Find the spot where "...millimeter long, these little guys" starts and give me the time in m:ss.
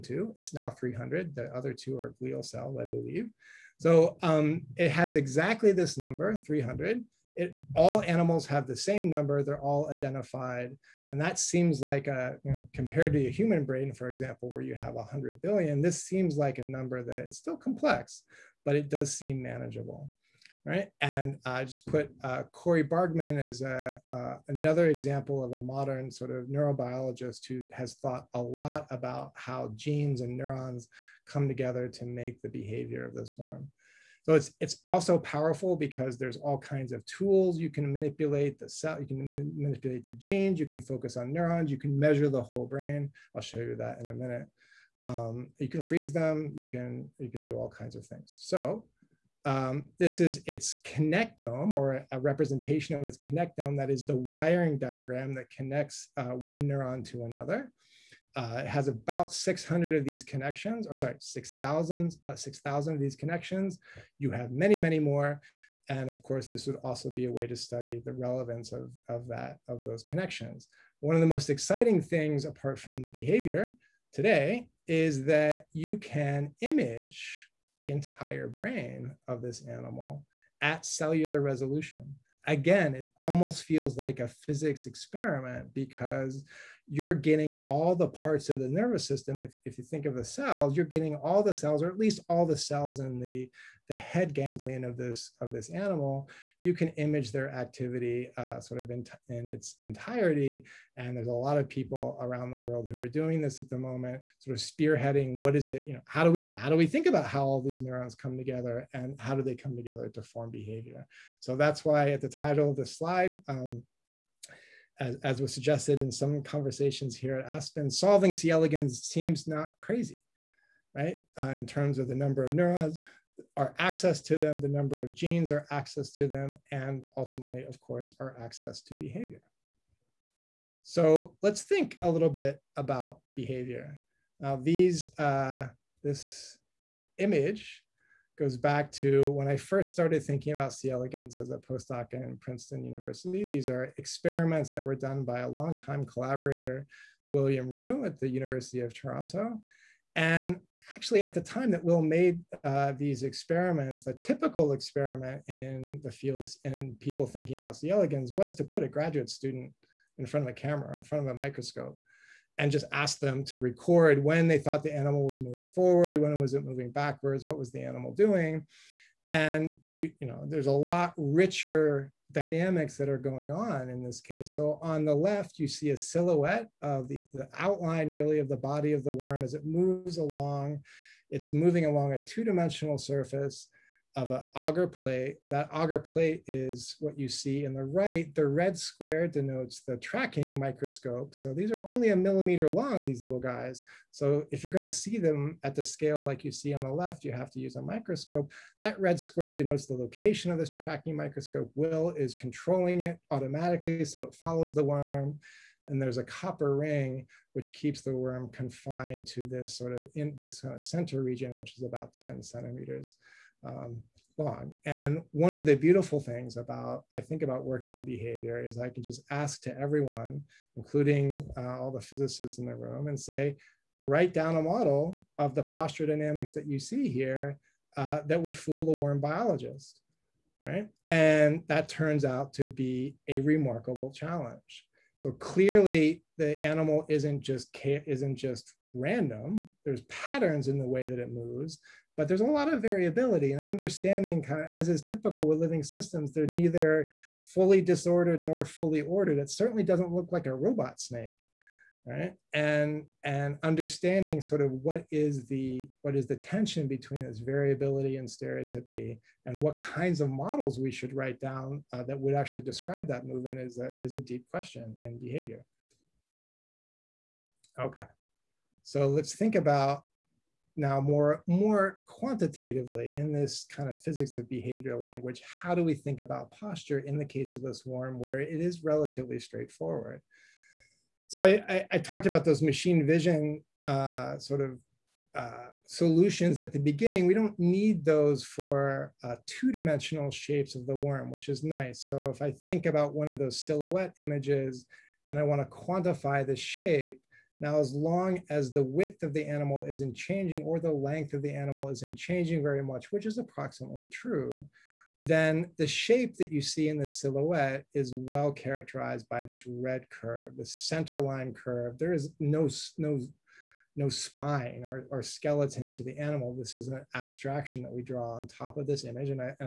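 3:12.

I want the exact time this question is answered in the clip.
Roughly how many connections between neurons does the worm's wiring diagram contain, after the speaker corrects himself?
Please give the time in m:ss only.
1:01.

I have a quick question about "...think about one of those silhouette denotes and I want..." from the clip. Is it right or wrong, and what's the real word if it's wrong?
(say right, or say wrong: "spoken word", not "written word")
wrong: "images", not "denotes".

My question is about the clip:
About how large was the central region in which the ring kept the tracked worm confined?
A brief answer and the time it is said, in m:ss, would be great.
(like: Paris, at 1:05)
10 centimeters, at 3:32.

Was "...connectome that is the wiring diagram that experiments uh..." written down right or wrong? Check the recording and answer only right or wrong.
wrong.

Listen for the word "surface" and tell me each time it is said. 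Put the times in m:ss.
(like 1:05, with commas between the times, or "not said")
3:02.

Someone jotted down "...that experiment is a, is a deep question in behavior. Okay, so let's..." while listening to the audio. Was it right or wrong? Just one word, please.
wrong.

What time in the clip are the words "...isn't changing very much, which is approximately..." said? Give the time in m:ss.
5:01.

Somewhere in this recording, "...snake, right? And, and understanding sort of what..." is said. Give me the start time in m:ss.
4:10.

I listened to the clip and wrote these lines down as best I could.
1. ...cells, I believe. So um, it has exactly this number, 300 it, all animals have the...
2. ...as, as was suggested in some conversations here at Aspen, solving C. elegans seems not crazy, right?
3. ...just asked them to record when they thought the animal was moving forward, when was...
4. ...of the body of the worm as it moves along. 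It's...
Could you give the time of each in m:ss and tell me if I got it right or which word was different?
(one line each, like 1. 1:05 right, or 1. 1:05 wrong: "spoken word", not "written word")
1. 0:02 right
2. 1:54 right
3. 2:42 right
4. 2:58 right.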